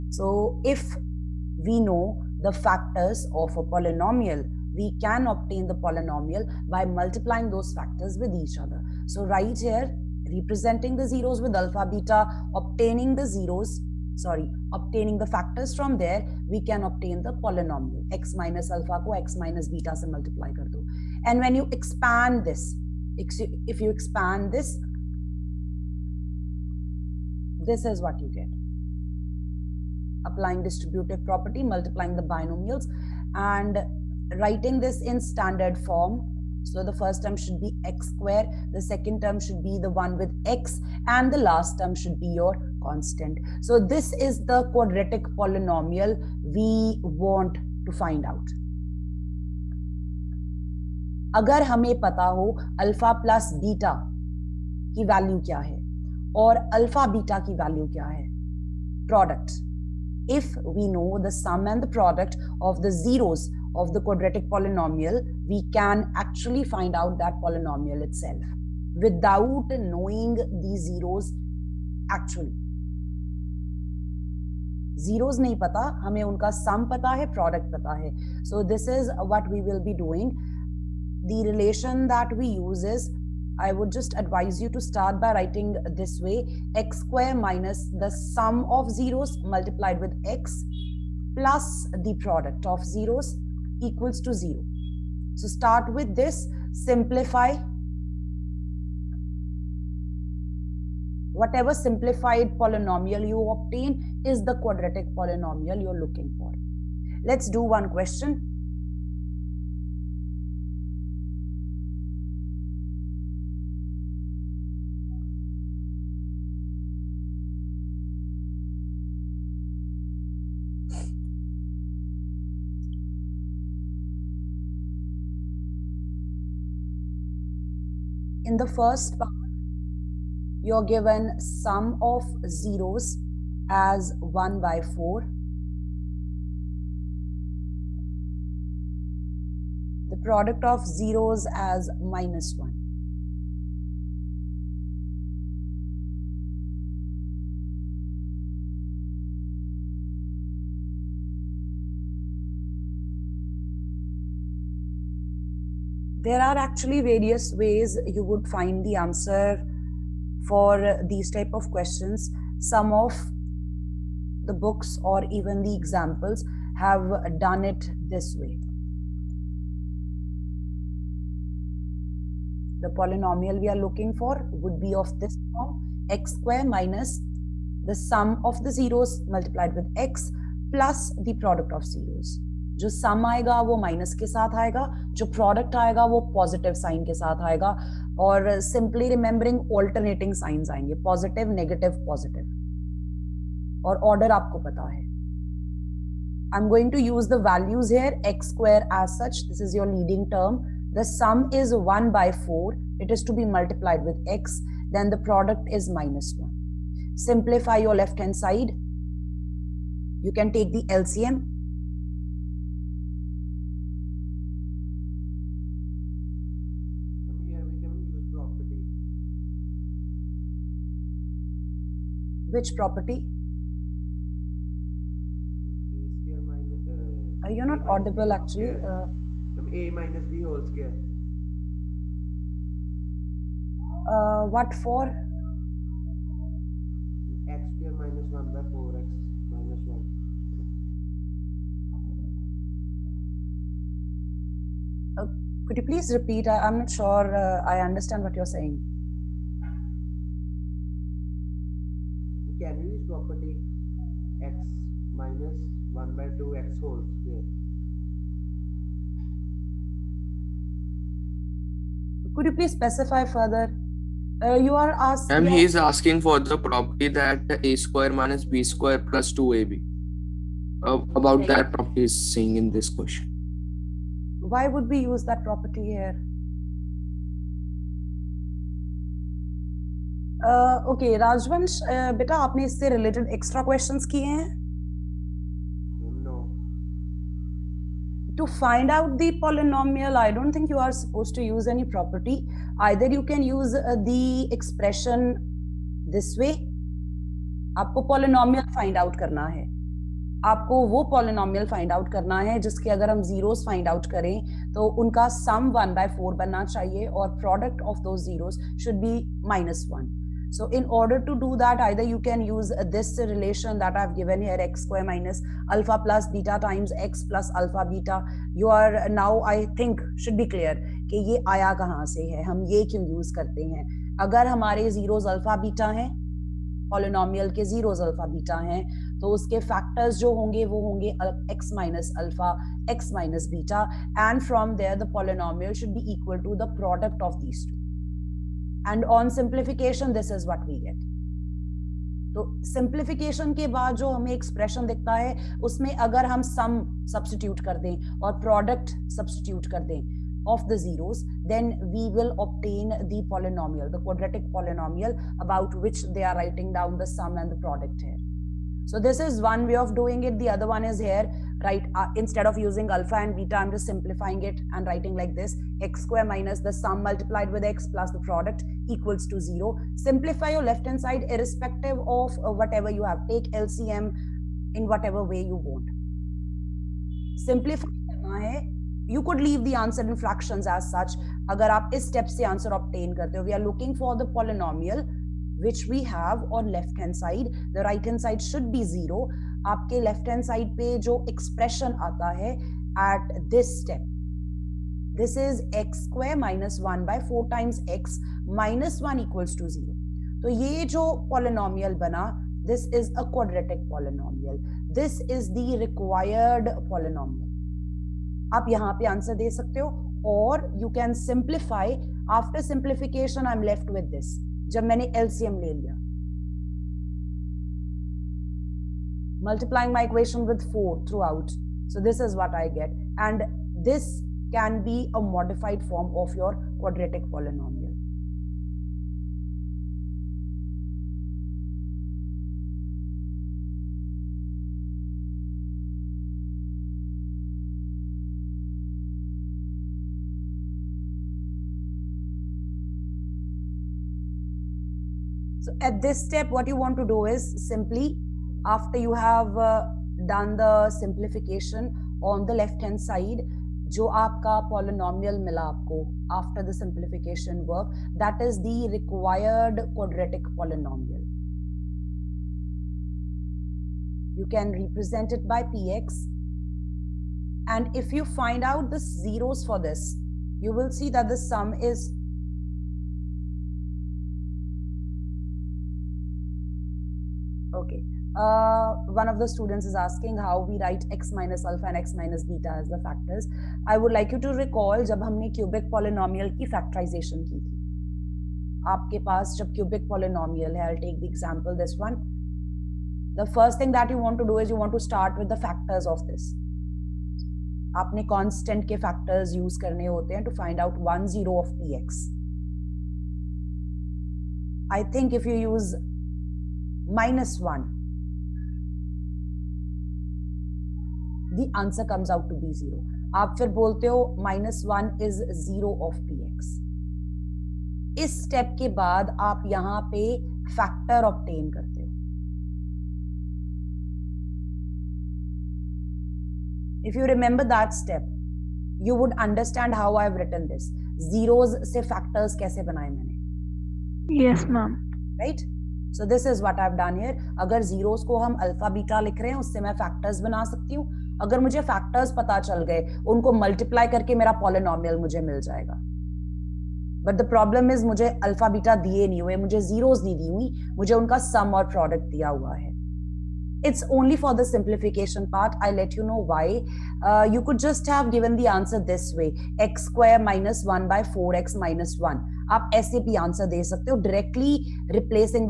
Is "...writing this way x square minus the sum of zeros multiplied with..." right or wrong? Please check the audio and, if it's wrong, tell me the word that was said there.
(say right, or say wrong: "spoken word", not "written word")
right.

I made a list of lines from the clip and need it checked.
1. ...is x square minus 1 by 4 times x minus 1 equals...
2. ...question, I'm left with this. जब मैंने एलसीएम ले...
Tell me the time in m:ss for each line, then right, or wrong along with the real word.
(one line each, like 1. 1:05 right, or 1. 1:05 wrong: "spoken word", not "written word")
1. 6:35 right
2. 6:52 wrong: "simplification", not "question".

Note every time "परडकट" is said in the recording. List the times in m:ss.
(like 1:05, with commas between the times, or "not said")
0:59, 3:05, 3:25, 5:07, 5:48, 9:11.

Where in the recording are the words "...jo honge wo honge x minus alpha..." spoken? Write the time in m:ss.
5:30.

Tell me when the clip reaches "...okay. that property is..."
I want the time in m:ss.
4:31.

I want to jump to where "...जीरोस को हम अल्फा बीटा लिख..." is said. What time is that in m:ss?
8:57.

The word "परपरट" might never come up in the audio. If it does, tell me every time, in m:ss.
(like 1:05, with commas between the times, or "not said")
4:51.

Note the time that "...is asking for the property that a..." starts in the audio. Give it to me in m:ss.
4:25.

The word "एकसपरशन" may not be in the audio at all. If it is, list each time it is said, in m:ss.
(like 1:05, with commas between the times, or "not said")
4:54, 5:44.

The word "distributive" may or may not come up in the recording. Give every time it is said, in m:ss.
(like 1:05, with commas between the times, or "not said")
0:30.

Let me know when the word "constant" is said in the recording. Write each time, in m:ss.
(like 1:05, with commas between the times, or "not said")
0:42, 8:18.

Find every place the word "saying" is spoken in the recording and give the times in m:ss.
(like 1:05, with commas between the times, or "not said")
4:08, 4:32.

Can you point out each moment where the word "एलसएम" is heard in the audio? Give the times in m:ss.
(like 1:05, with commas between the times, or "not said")
6:55.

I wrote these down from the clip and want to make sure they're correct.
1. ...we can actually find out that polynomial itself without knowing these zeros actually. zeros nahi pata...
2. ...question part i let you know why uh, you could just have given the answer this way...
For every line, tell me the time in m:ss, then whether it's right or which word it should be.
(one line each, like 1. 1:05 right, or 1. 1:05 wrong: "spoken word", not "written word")
1. 1:05 right
2. 9:14 wrong: "simplification", not "question".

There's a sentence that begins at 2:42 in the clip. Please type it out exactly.
Some of the books or even the examples have done it this way.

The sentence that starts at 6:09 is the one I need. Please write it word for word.
Simplify your left-hand side irrespective of uh, whatever you have.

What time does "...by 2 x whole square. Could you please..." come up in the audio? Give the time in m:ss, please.
4:16.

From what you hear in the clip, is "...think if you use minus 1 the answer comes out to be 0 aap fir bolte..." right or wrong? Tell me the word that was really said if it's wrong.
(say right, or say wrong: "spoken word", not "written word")
right.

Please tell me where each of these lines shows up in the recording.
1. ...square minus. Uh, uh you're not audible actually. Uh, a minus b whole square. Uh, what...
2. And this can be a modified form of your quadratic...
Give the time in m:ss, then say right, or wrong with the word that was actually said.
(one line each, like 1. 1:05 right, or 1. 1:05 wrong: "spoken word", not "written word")
1. 3:46 right
2. 7:03 right.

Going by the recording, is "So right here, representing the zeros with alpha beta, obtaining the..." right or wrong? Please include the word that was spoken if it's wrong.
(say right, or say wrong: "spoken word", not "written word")
right.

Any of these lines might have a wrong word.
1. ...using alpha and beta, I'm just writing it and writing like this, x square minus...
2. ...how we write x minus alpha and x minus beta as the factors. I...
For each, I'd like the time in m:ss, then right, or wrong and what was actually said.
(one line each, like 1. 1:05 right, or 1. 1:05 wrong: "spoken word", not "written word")
1. 6:02 wrong: "simplifying", not "writing"
2. 8:00 right.